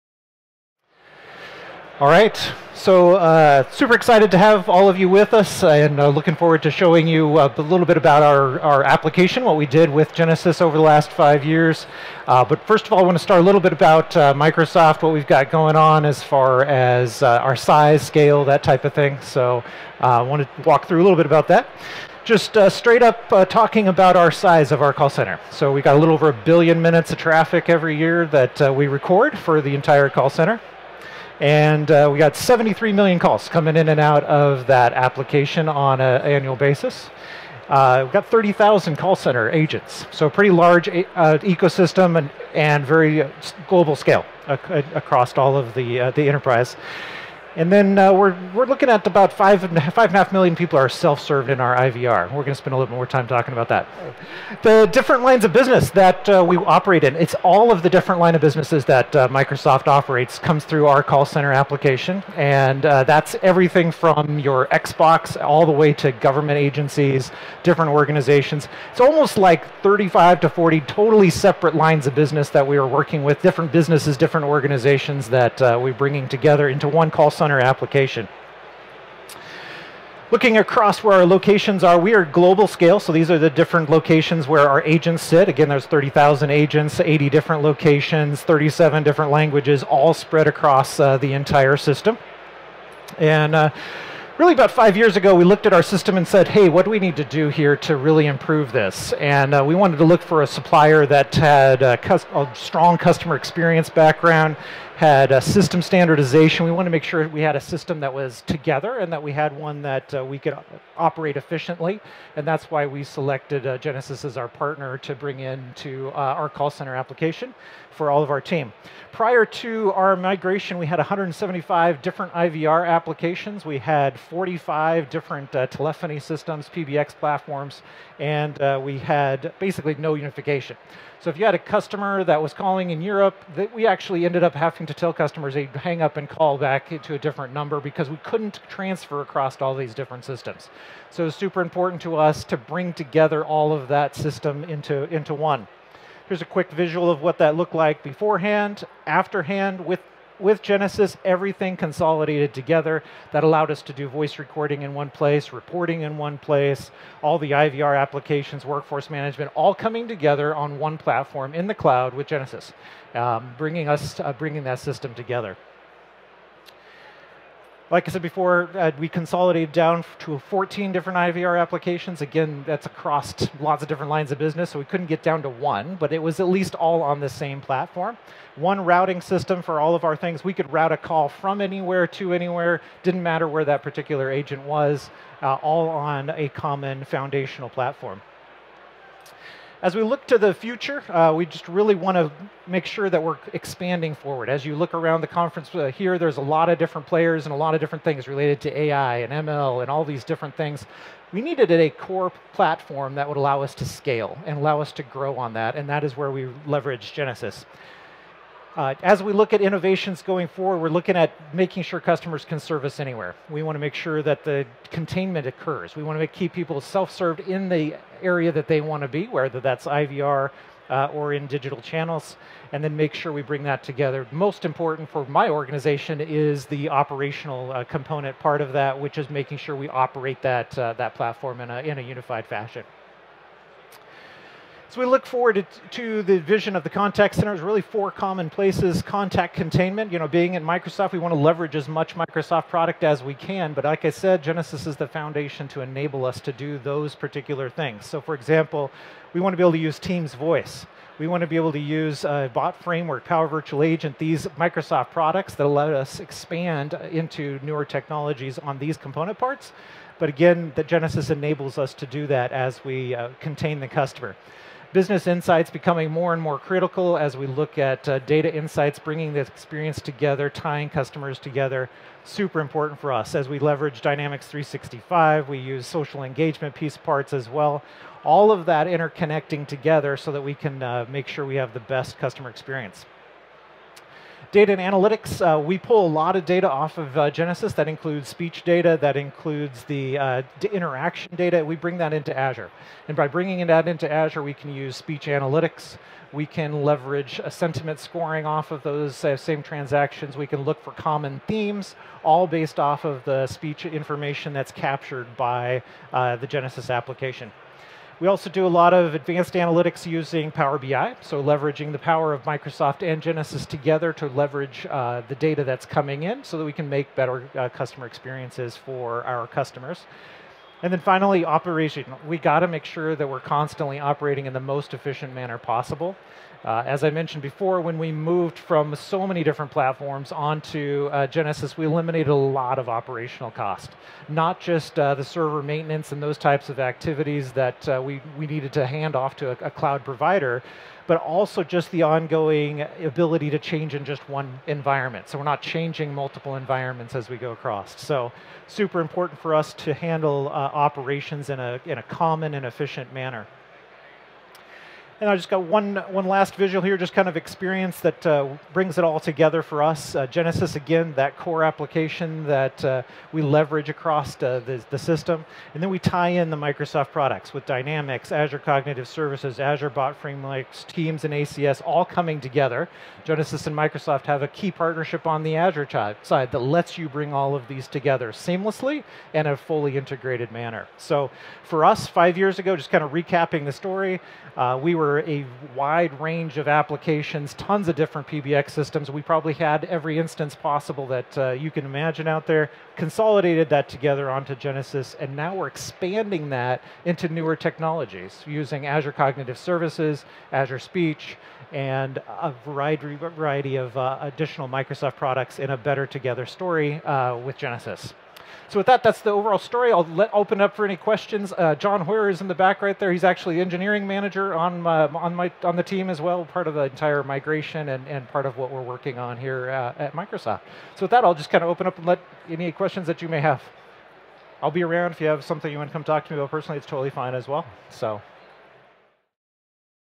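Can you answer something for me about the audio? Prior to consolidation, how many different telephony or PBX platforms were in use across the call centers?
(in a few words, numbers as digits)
45.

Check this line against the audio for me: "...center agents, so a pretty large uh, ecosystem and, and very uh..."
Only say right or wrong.
right.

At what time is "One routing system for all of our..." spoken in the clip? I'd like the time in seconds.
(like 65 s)
178 s.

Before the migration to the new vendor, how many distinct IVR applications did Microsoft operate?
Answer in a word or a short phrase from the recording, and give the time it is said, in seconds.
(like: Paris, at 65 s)
175, at 120 s.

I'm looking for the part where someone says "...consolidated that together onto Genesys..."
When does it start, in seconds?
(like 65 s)
392 s.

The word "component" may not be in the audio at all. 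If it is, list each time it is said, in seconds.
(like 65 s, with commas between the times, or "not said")
227 s, 258 s.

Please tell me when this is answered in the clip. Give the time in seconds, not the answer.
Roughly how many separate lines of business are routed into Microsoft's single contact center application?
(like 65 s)
69 s.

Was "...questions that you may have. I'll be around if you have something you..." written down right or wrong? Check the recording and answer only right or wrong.
right.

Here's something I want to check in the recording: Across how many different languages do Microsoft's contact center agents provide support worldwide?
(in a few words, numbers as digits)
37.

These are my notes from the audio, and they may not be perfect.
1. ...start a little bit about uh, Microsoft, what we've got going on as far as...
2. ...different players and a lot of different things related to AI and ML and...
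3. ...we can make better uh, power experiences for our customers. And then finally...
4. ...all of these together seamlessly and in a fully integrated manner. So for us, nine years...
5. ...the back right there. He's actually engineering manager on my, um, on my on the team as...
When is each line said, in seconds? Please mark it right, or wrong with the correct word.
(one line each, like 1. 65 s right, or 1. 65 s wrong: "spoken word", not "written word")
1. 13 s right
2. 196 s right
3. 316 s wrong: "customer", not "power"
4. 377 s wrong: "five", not "nine"
5. 412 s right.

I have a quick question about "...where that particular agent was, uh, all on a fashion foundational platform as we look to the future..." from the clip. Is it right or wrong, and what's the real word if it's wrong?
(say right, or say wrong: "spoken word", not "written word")
wrong: "common", not "fashion".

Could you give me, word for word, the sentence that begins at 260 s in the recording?
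But again, the Genesys enables us to do that as we uh, contain the customer.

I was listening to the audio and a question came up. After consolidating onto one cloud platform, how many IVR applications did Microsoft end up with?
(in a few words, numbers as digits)
14.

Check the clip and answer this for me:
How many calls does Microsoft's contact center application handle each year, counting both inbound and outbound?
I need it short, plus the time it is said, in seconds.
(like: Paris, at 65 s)
73 million, at 32 s.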